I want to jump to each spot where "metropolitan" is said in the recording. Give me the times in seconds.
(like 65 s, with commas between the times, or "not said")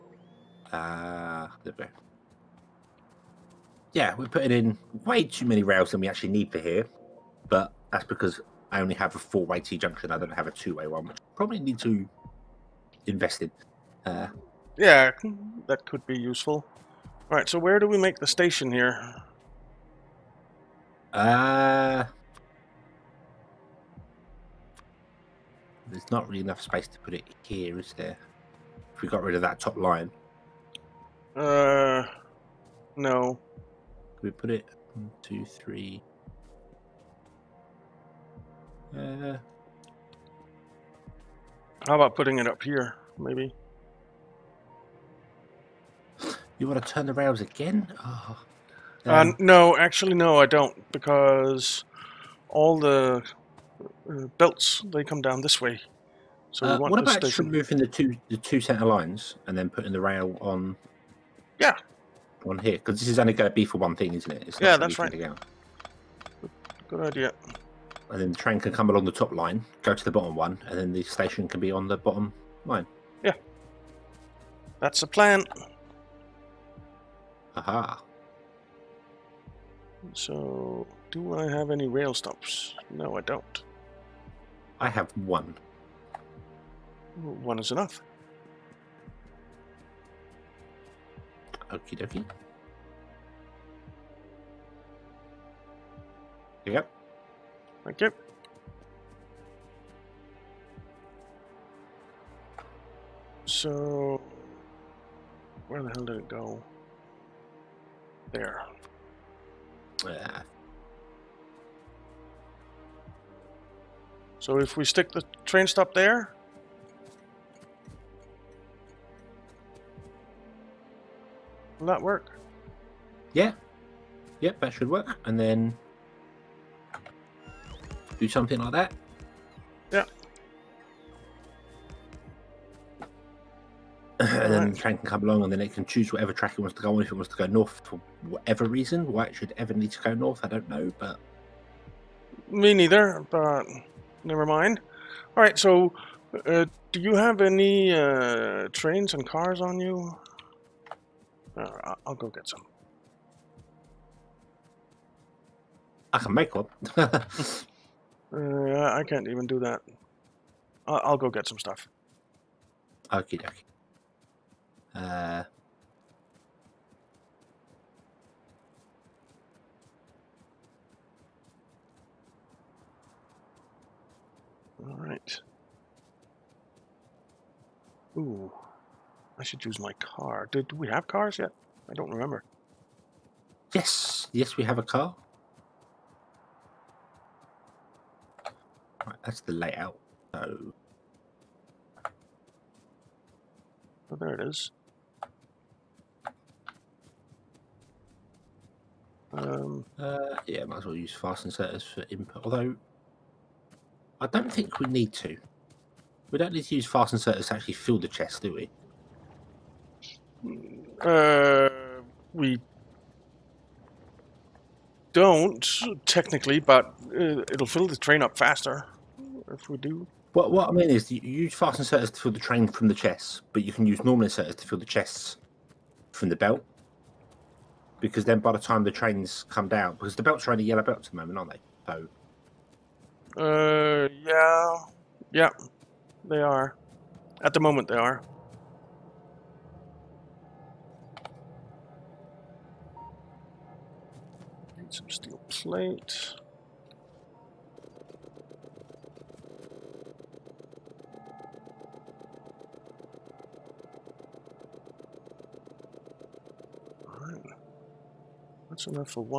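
not said.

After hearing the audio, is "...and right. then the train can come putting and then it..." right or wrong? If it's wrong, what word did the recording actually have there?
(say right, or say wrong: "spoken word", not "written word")
wrong: "along", not "putting".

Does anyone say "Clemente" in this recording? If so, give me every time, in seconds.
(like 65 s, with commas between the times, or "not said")
not said.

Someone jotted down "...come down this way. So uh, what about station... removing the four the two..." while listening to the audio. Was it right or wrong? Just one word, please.
wrong.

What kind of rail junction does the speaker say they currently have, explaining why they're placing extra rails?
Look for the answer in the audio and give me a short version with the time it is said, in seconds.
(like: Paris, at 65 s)
four-way T junction, at 9 s.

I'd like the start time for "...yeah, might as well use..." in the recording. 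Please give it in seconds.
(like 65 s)
200 s.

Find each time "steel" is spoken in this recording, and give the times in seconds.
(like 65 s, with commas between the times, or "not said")
245 s.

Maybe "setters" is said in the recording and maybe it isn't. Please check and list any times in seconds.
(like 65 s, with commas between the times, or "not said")
201 s, 207 s, 224 s.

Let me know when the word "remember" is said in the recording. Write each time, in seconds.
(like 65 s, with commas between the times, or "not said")
182 s.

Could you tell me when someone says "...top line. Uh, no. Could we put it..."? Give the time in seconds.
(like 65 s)
29 s.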